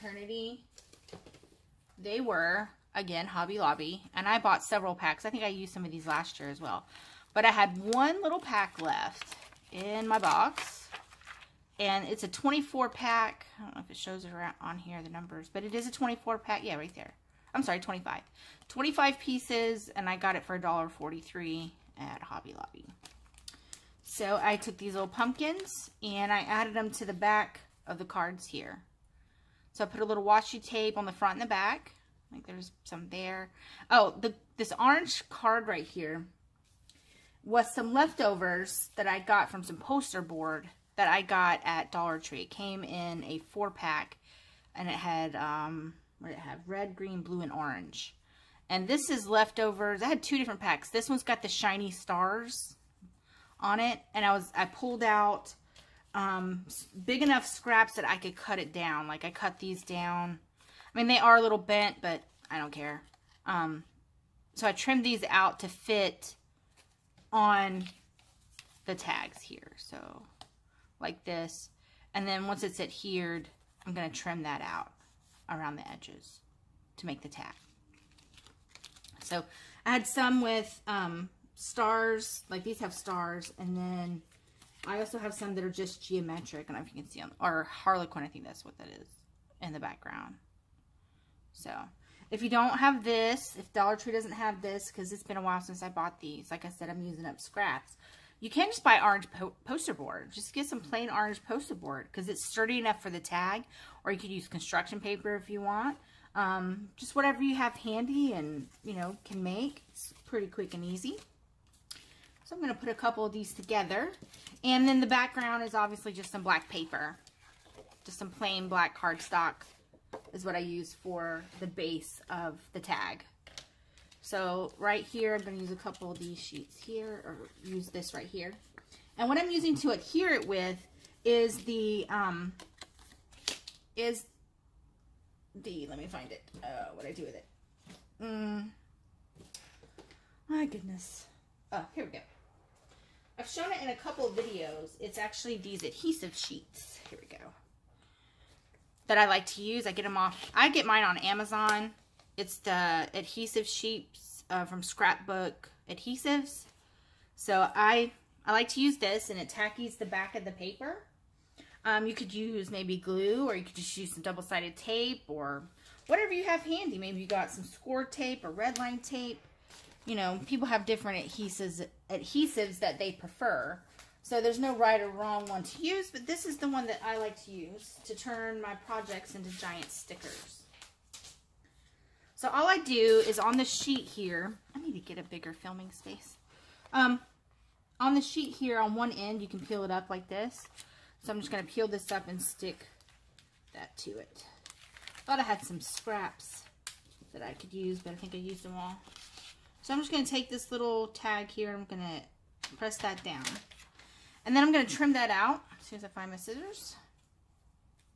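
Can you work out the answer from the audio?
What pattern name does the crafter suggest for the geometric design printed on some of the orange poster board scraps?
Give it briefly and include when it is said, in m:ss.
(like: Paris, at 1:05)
Harlequin, at 1:27.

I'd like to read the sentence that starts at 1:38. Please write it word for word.
You can just buy orange po poster board.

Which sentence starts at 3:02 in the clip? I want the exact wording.
So all I do is on the sheet here, I need to get a bigger filming space.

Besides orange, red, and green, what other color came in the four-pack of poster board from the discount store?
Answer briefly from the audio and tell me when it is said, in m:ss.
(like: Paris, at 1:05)
Blue, at 0:47.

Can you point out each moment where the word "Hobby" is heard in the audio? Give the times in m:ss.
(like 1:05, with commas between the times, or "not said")
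0:03, 0:22.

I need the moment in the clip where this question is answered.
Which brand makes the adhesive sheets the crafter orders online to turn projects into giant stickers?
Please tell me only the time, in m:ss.
2:34.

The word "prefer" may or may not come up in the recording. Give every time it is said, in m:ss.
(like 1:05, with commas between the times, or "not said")
2:53.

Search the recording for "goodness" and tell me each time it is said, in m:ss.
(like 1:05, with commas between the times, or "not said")
2:20.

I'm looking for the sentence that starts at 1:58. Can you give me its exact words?
Just some plain black cardstock is what I use for the base of the tag.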